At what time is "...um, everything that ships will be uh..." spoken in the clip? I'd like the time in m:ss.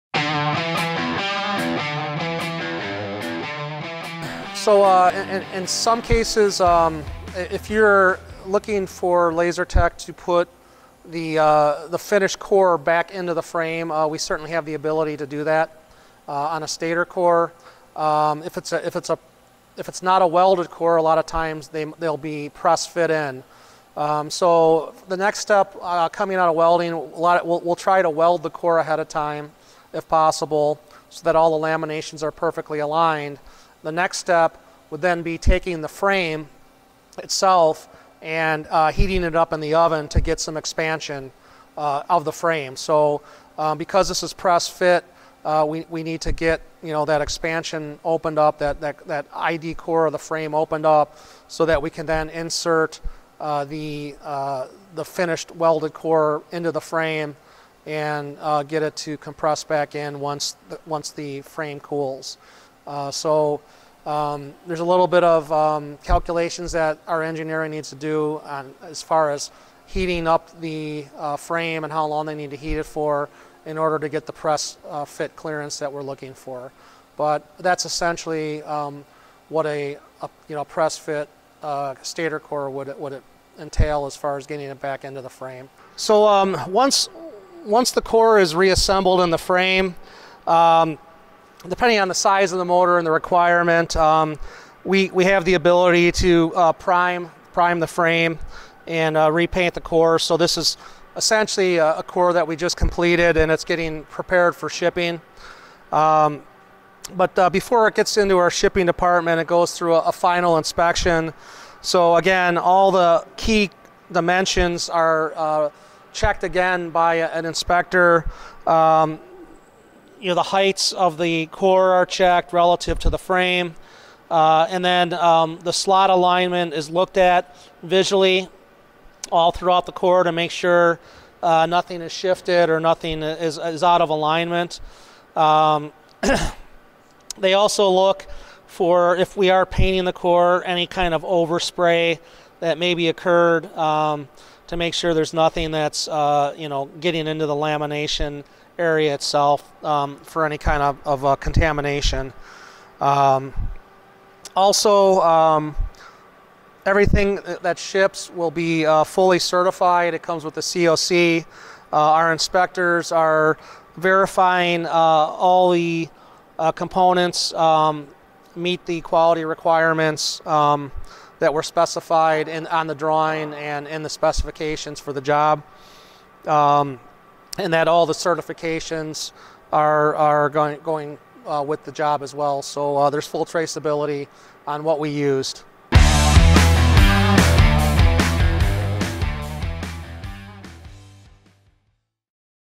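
2:35.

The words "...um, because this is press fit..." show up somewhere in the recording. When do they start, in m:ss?
0:43.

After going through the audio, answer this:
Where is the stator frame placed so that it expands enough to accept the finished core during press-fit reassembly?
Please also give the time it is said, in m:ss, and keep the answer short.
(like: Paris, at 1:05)
In the oven, at 0:39.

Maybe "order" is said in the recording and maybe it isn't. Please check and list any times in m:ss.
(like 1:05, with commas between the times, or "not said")
1:13.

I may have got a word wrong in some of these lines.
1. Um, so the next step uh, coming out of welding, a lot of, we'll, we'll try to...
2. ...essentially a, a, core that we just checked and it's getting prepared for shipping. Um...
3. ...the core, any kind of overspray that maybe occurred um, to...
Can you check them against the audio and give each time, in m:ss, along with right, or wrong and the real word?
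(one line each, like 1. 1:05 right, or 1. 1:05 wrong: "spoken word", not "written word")
1. 0:23 right
2. 1:41 wrong: "completed", not "checked"
3. 2:20 right.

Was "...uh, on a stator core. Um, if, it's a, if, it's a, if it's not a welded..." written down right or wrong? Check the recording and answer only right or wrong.
right.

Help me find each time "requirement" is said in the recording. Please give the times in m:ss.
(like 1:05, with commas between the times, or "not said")
1:33, 2:49.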